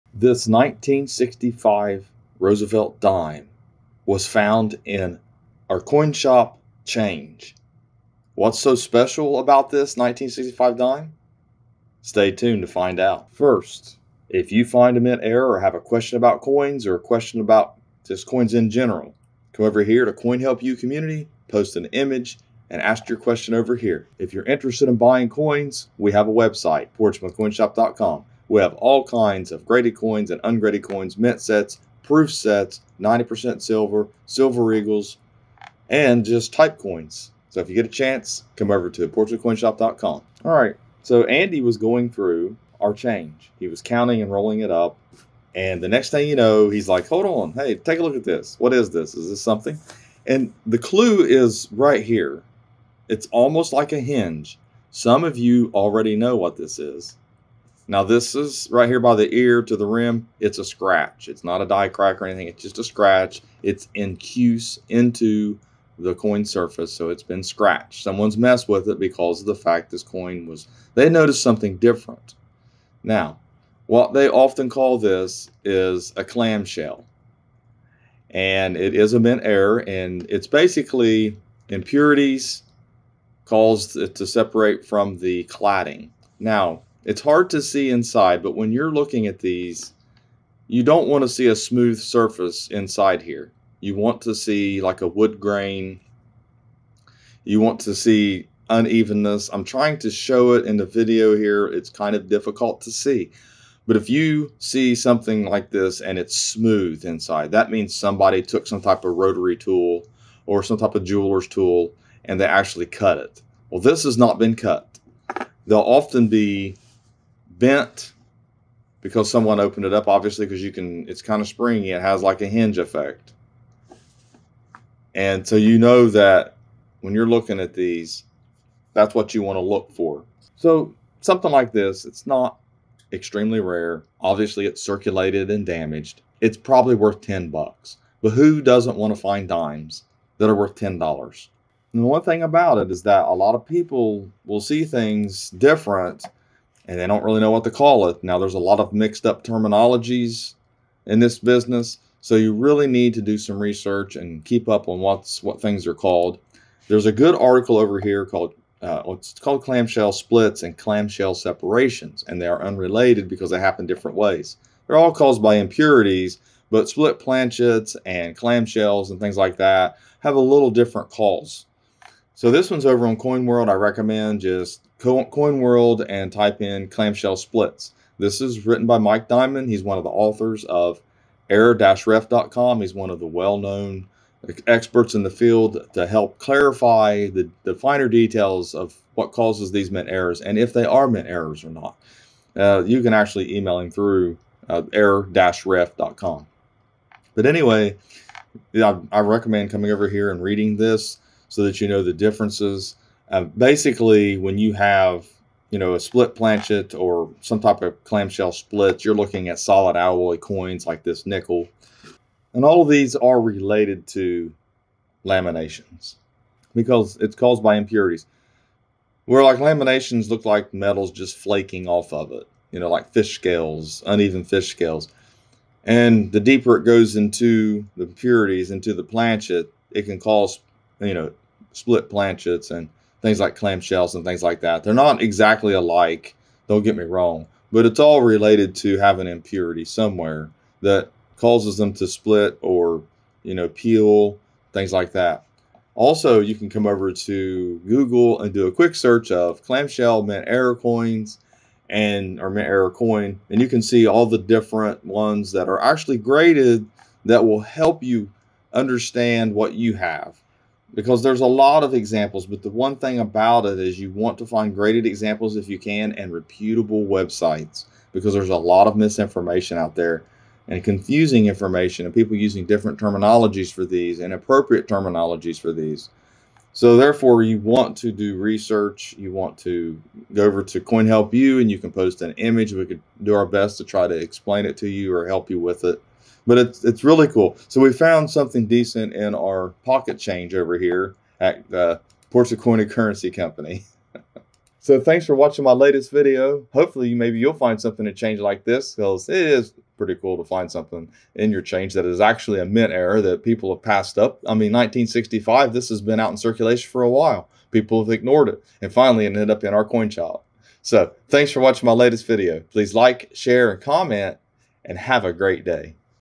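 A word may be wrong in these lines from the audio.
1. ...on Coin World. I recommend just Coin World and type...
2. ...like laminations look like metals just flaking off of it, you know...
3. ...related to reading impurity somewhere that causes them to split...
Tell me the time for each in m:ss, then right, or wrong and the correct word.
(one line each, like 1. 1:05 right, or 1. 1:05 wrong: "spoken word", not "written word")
1. 2:53 right
2. 3:39 right
3. 3:58 wrong: "having", not "reading".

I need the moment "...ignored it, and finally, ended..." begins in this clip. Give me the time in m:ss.
5:08.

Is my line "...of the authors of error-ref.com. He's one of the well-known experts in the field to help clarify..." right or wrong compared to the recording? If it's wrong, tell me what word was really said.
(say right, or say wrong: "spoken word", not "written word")
right.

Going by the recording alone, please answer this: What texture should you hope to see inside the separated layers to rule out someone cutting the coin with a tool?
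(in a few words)
Wood grain.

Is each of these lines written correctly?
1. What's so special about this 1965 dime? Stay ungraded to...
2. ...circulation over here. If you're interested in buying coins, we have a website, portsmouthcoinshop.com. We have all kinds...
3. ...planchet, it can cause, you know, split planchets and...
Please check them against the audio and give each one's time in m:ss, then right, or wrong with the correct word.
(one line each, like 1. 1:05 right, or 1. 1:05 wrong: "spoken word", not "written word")
1. 0:08 wrong: "tuned", not "ungraded"
2. 0:23 wrong: "question", not "circulation"
3. 3:49 right.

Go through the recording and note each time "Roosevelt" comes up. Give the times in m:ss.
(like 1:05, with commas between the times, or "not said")
0:02.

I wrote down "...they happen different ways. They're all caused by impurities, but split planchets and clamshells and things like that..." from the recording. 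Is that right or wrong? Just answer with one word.
right.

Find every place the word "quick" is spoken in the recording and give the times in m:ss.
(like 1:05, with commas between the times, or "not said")
4:08.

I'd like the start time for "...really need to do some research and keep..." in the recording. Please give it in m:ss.
2:32.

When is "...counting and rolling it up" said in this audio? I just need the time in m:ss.
0:43.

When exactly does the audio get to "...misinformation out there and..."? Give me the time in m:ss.
4:28.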